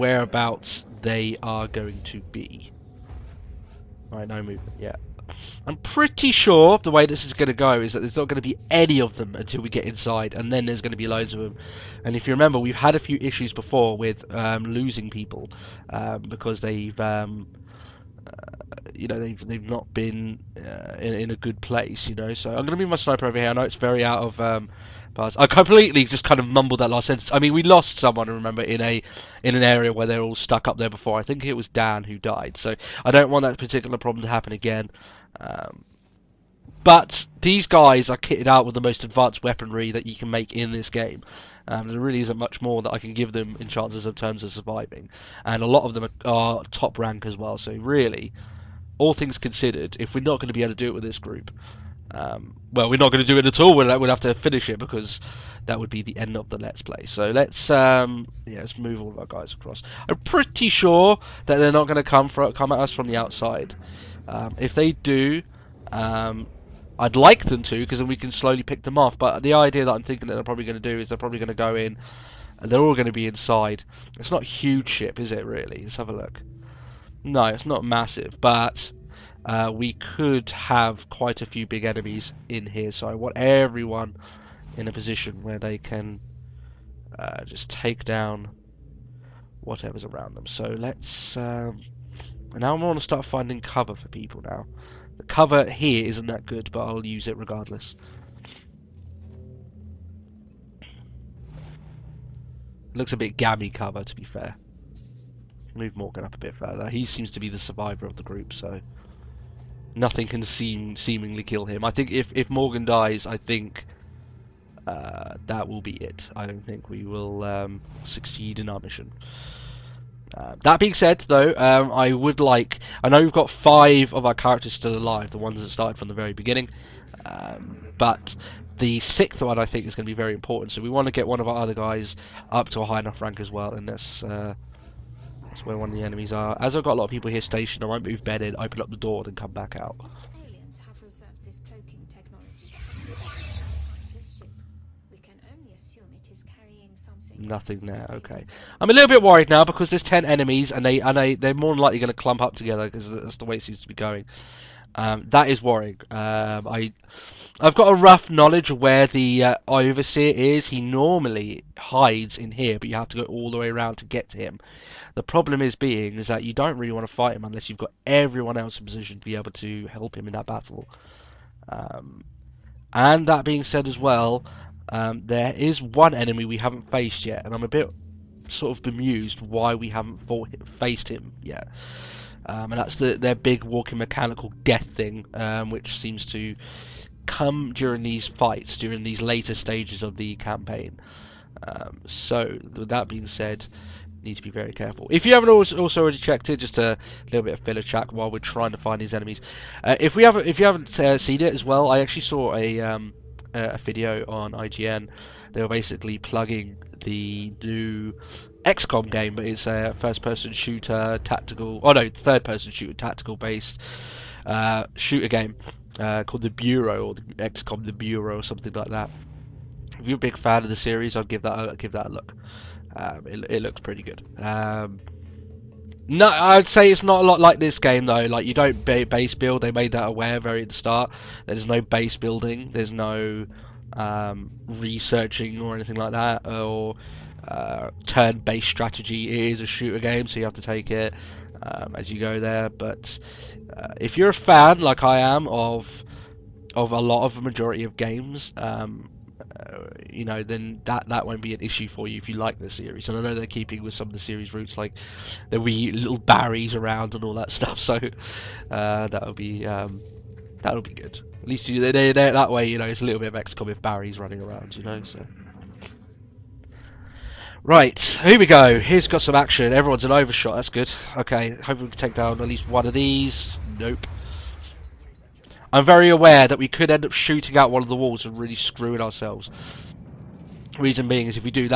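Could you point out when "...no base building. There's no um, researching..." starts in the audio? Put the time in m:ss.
3:51.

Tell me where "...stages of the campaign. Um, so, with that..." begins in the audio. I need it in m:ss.
3:09.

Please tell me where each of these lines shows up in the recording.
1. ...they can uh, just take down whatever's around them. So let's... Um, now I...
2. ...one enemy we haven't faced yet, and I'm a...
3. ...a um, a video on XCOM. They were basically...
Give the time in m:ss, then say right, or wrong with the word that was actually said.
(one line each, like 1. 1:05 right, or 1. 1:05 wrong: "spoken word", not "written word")
1. 1:25 right
2. 2:55 right
3. 3:22 wrong: "IGN", not "XCOM".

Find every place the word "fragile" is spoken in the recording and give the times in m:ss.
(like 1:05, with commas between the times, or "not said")
not said.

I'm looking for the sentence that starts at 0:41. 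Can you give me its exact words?
Um, there really isn't much more that I can give them in chances of terms of surviving.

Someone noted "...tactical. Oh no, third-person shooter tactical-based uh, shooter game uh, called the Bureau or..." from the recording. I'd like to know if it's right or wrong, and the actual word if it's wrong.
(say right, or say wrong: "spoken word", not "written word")
right.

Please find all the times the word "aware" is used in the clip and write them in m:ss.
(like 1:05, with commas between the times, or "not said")
3:50, 4:36.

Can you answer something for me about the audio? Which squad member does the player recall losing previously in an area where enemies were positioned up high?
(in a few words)
Dan.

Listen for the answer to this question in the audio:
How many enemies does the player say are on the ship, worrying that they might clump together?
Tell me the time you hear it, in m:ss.
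2:30.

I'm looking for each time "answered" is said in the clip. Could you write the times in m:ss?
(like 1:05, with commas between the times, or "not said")
not said.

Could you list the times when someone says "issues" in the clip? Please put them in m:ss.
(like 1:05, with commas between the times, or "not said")
0:13, 4:11.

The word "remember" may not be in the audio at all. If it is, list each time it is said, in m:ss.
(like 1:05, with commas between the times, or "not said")
0:12, 0:28.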